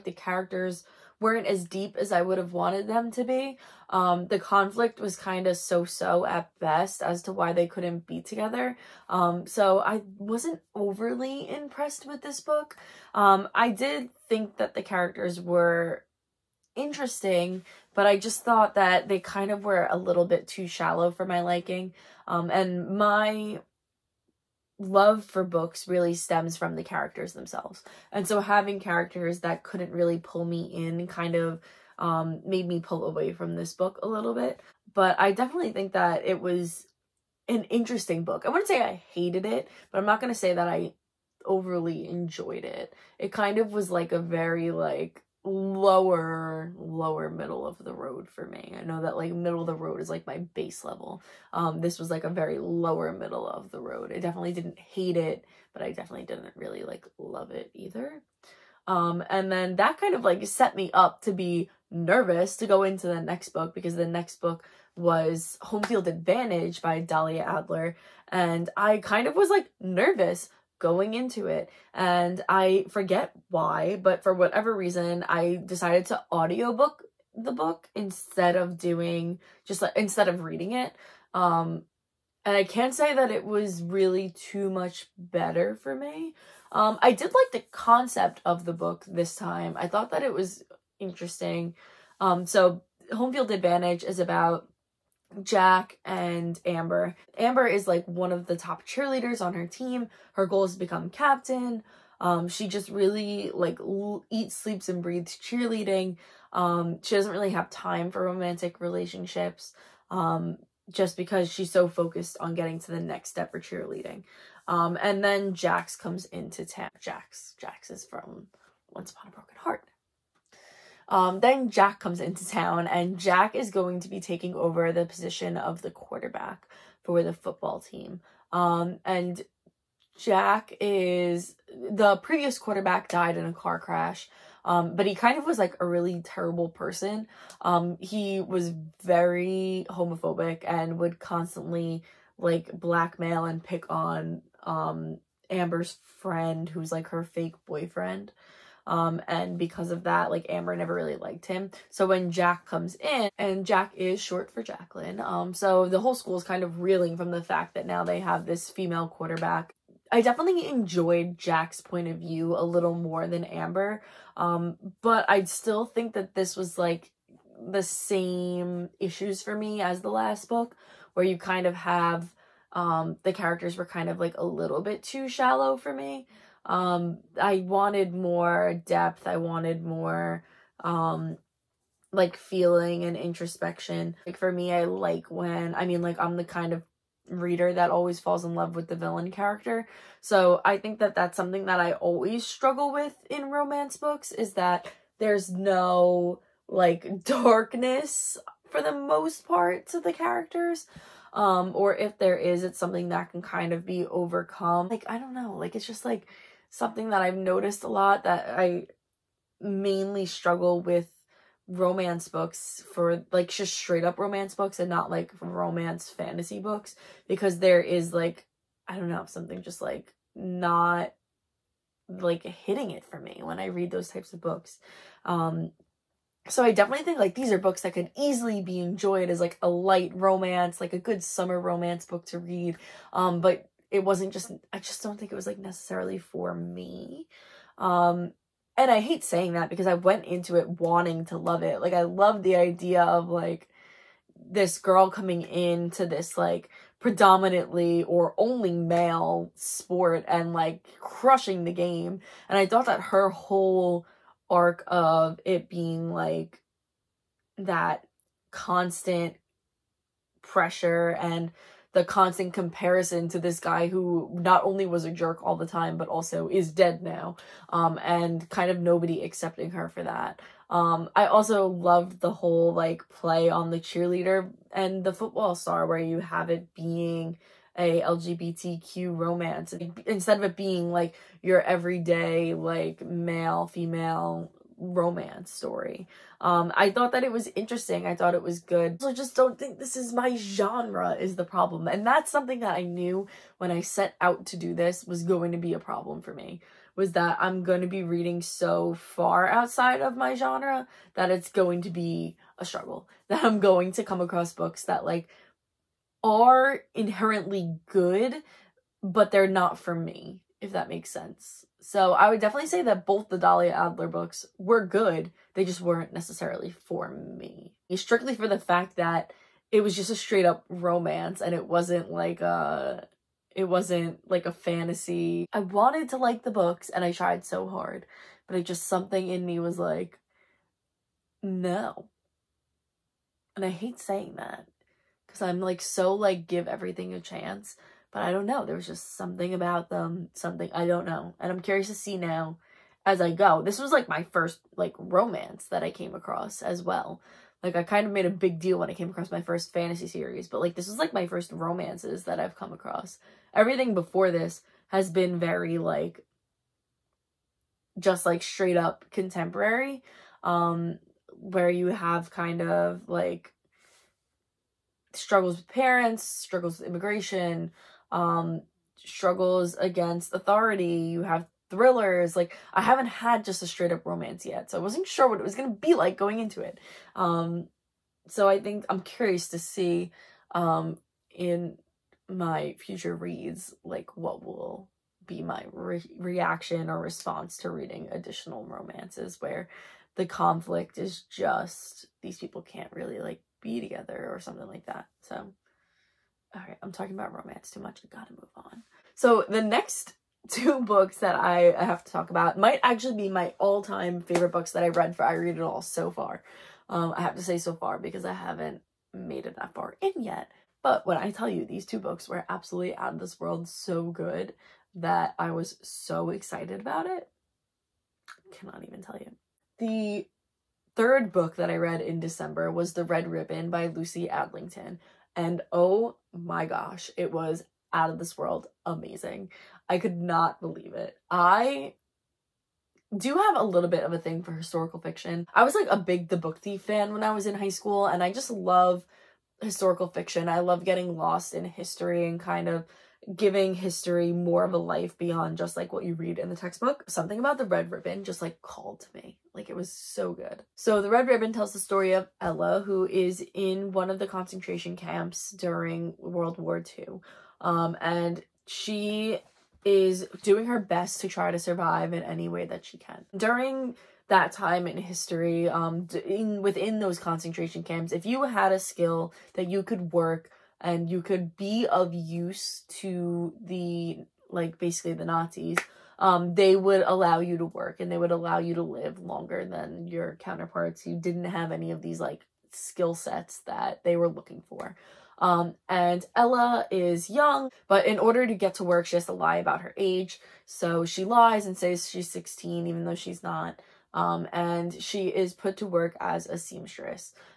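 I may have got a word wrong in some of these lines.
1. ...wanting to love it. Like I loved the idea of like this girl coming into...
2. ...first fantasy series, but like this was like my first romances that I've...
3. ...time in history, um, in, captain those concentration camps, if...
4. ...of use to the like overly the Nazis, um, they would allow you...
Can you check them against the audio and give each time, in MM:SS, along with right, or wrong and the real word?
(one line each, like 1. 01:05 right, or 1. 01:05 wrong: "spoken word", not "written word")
1. 04:00 right
2. 05:49 right
3. 07:44 wrong: "within", not "captain"
4. 07:51 wrong: "basically", not "overly".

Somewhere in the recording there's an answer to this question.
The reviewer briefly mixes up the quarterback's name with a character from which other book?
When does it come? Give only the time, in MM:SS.
01:58.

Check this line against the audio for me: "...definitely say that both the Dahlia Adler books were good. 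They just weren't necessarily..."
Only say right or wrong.
right.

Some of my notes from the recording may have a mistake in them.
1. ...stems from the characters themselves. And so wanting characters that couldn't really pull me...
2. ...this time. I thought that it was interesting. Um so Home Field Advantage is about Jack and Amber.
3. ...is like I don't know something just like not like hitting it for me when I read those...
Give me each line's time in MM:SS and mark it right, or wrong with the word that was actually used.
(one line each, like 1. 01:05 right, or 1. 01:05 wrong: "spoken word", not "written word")
1. 00:26 wrong: "having", not "wanting"
2. 01:29 right
3. 03:37 right.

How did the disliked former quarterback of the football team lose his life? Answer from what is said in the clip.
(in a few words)
A car crash.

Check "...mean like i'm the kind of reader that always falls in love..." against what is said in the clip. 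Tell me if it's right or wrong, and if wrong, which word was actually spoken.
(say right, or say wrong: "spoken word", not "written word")
right.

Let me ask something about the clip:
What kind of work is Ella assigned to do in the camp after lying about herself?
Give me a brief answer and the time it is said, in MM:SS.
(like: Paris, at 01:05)
Seamstress, at 08:16.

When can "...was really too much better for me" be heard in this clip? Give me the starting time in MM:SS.
01:23.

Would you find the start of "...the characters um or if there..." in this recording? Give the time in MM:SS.
03:20.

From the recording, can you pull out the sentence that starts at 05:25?
I wanted to like the books and I tried so hard, but it just something in me was like no.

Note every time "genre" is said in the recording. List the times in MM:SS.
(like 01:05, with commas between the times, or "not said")
04:50, 05:00.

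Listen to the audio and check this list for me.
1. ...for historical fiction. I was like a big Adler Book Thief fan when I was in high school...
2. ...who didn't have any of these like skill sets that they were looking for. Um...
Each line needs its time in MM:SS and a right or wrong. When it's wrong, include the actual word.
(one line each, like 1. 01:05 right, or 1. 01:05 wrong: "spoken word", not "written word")
1. 07:14 wrong: "The", not "Adler"
2. 08:01 right.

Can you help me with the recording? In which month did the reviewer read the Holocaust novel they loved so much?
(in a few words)
December.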